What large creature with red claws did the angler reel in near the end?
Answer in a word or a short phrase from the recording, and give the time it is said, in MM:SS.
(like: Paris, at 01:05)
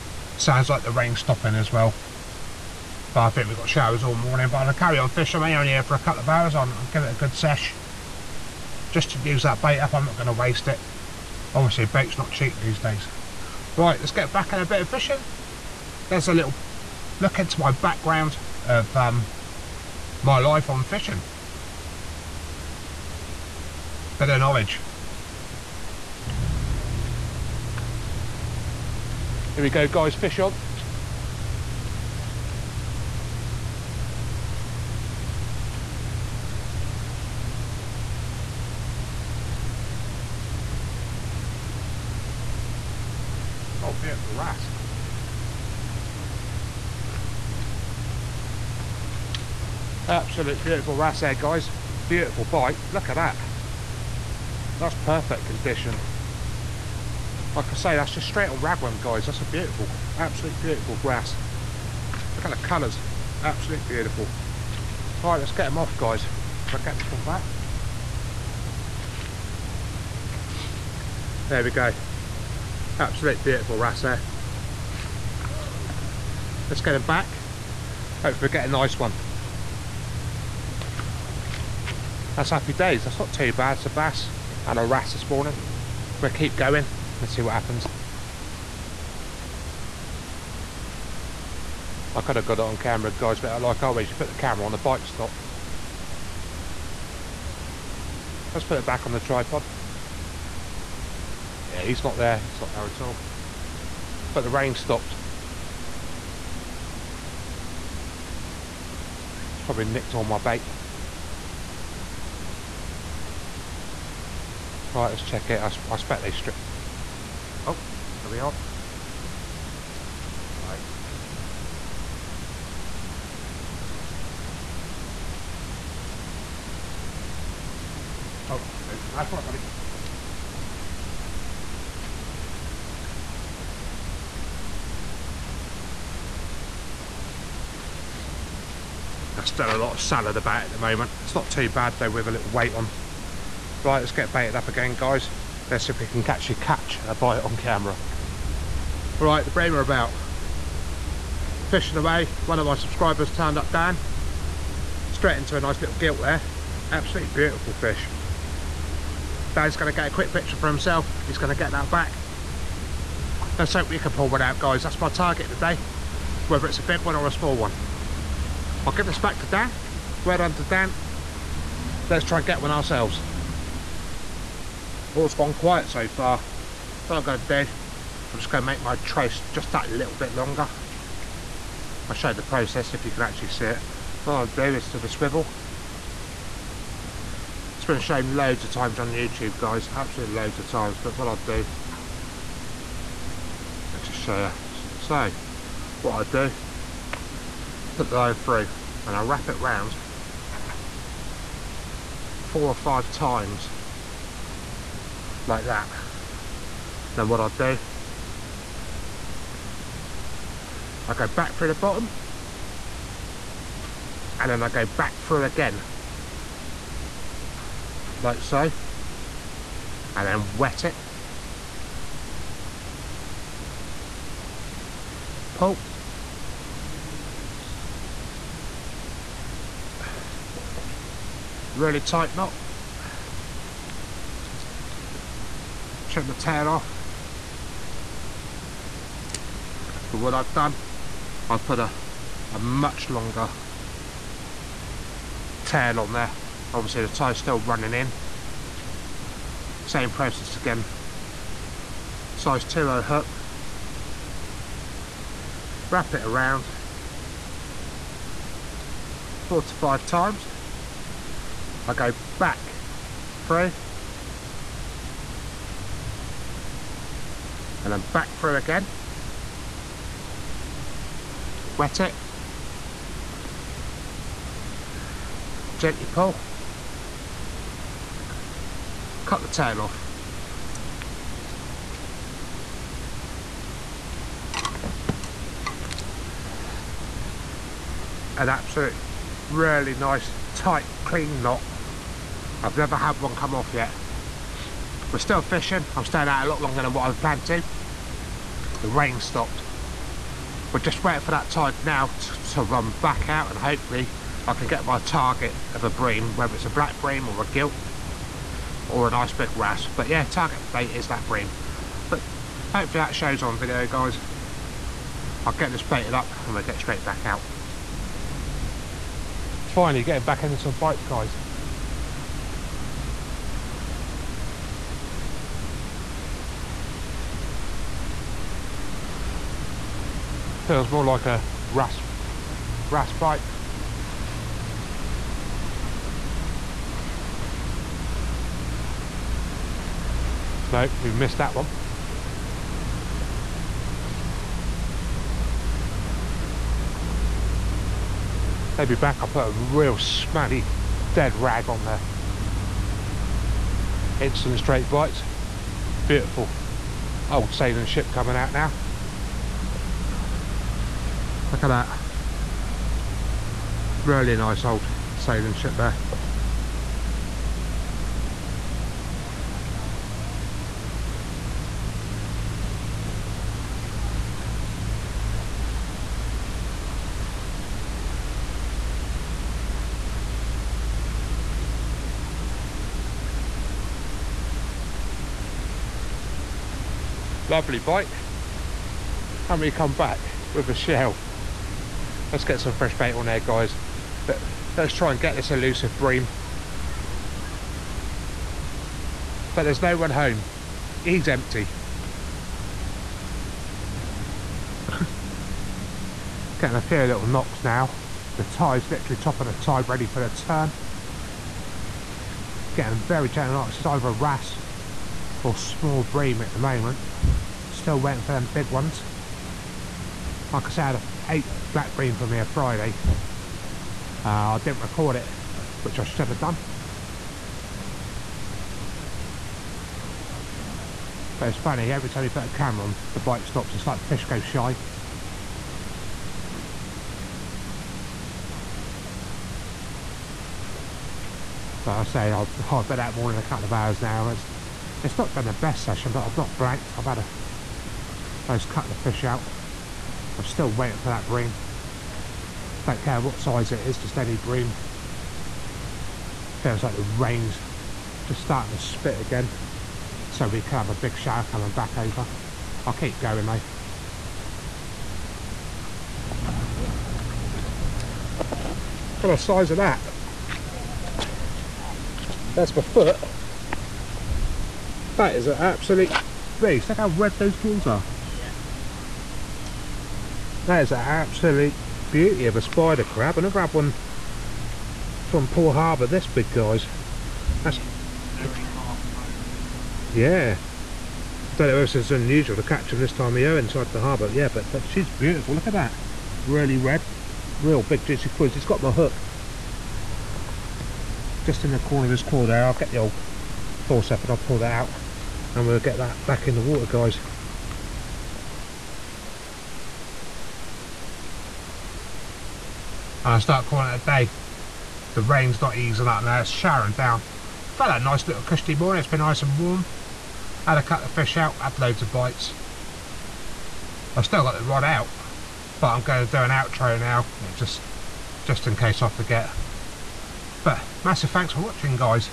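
spider crab, at 08:02.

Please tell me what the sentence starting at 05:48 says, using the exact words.
Maybe back I put a real smelly dead rag on there.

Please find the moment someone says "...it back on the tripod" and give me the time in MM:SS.
01:38.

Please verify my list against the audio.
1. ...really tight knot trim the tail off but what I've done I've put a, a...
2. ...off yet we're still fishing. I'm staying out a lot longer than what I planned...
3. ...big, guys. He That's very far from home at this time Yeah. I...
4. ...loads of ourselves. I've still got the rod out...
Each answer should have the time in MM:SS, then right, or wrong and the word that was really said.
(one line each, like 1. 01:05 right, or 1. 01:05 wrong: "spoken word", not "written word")
1. 03:51 right
2. 04:53 right
3. 08:06 right
4. 08:41 wrong: "bites", not "ourselves".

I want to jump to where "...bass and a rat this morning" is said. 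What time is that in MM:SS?
01:23.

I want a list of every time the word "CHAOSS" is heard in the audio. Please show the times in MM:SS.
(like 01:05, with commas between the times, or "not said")
not said.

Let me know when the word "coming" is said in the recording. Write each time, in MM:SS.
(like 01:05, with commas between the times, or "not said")
05:58, 07:41.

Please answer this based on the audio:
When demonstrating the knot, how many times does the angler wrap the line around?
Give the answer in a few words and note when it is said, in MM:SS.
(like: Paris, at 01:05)
4 or 5, at 03:22.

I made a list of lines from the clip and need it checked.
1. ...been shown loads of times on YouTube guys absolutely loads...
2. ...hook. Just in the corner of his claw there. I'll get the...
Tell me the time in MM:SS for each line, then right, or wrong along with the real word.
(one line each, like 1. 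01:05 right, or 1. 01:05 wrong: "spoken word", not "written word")
1. 03:07 right
2. 08:18 right.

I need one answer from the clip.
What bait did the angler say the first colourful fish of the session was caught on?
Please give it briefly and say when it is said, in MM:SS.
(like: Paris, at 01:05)
ragworm, at 00:58.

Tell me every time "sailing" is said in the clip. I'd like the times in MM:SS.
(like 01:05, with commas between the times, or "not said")
05:57, 06:05.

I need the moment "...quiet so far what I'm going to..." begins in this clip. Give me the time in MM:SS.
02:55.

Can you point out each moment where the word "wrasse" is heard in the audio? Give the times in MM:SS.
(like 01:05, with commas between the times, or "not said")
00:44, 00:50, 01:01, 01:13, 05:09, 06:54.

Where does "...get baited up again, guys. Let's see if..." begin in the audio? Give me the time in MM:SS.
02:24.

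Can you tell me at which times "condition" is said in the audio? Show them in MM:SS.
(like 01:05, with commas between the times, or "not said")
00:55.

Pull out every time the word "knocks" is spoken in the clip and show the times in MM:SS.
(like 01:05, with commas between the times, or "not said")
06:47, 06:53.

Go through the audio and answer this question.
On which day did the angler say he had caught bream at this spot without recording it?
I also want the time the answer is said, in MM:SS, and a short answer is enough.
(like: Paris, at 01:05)
Friday, at 07:02.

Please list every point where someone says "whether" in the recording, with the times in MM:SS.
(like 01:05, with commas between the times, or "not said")
02:46, 05:06.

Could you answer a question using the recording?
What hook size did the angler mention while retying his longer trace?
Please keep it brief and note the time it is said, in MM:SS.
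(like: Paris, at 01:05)
2.0, at 04:12.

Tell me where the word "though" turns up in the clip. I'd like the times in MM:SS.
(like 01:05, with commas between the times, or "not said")
02:21, 07:43.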